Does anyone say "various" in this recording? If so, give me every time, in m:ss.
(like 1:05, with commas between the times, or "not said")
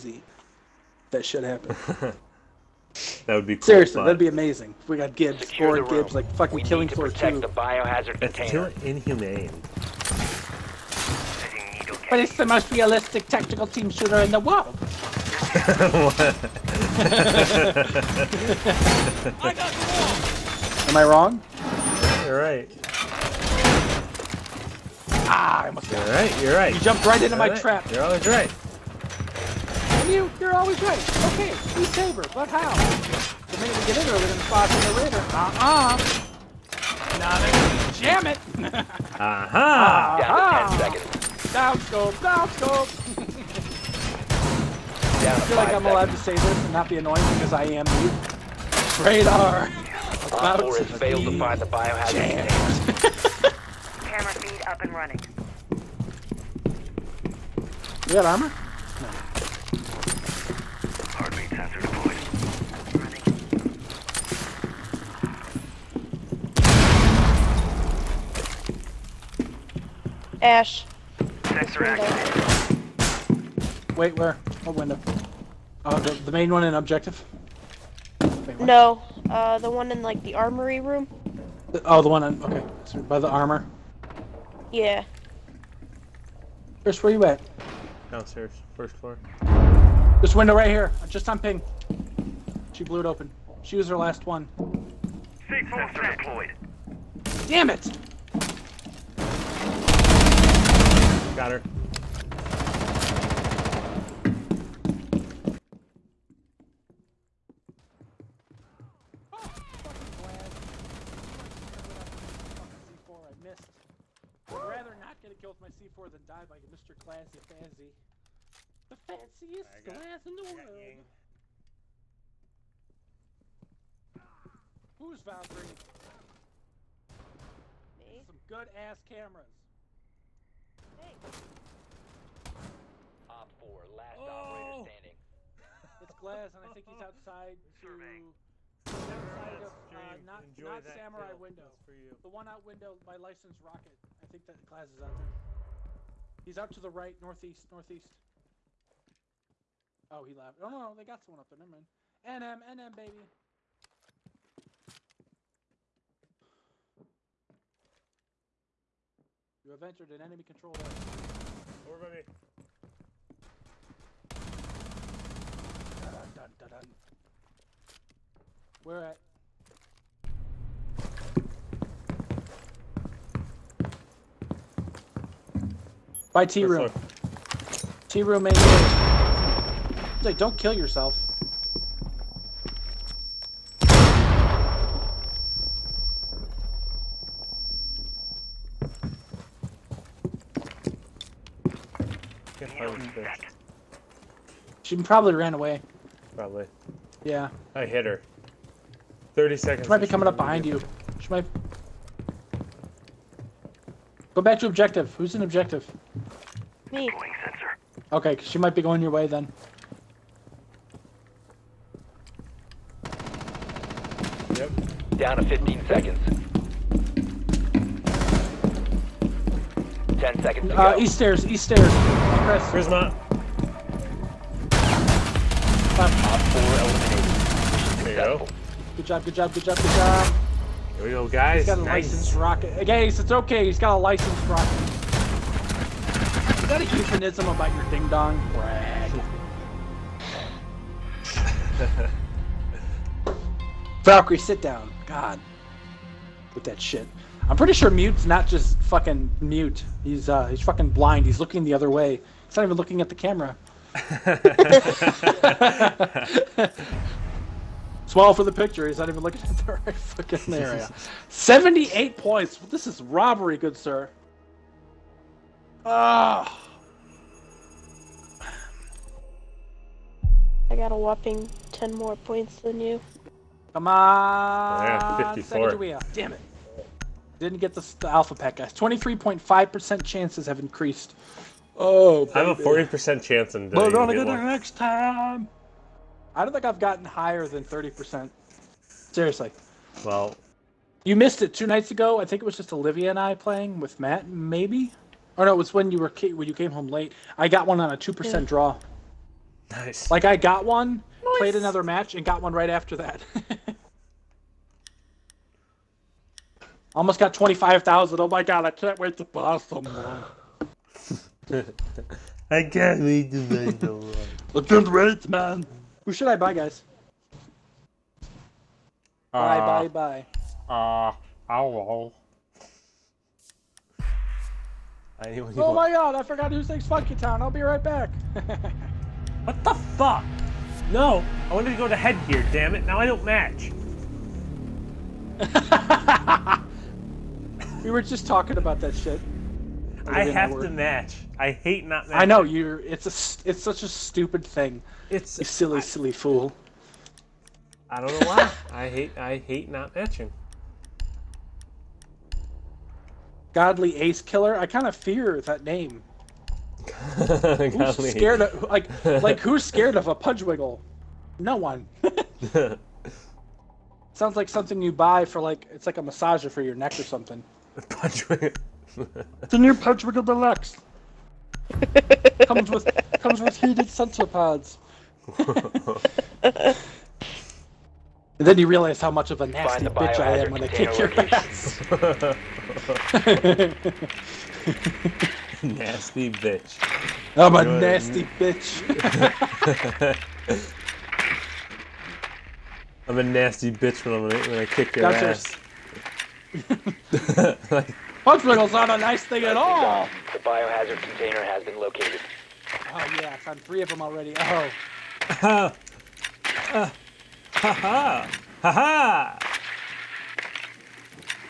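not said.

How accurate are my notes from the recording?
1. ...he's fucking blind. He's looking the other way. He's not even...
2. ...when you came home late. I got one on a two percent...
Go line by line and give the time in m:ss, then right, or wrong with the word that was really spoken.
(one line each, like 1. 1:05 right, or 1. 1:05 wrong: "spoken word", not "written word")
1. 4:10 right
2. 4:56 right.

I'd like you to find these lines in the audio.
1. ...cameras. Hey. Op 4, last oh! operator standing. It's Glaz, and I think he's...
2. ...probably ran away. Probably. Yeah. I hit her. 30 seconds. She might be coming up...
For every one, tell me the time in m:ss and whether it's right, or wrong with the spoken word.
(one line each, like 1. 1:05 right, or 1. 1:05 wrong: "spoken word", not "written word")
1. 2:09 right
2. 3:14 right.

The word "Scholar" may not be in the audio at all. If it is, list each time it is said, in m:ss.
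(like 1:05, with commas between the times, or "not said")
not said.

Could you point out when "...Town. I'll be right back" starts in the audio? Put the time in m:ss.
5:27.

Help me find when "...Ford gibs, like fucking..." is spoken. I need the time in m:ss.
0:05.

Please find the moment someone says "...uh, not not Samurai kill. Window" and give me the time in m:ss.
2:19.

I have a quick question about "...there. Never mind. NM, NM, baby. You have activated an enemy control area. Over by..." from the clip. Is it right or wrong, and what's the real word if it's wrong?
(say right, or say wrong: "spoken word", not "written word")
wrong: "entered", not "activated".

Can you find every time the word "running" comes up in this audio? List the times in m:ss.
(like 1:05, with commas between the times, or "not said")
0:54, 1:10.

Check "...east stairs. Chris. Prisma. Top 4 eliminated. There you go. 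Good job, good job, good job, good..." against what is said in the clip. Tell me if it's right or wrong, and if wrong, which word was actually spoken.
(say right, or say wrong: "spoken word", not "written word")
right.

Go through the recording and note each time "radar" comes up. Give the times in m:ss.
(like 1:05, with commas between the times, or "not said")
0:34, 0:49.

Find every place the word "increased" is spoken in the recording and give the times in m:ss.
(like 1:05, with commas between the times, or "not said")
4:40.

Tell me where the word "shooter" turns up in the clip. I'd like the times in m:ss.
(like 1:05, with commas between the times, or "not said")
0:13.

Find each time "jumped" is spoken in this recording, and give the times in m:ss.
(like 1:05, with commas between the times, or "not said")
0:26.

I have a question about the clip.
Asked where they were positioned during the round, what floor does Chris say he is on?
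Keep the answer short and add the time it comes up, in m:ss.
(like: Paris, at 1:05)
First floor, at 1:28.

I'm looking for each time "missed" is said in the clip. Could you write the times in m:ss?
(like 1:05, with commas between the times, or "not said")
1:53, 4:51.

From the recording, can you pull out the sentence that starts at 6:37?
like, not a nice thing at all!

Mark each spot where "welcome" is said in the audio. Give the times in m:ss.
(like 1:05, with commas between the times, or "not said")
not said.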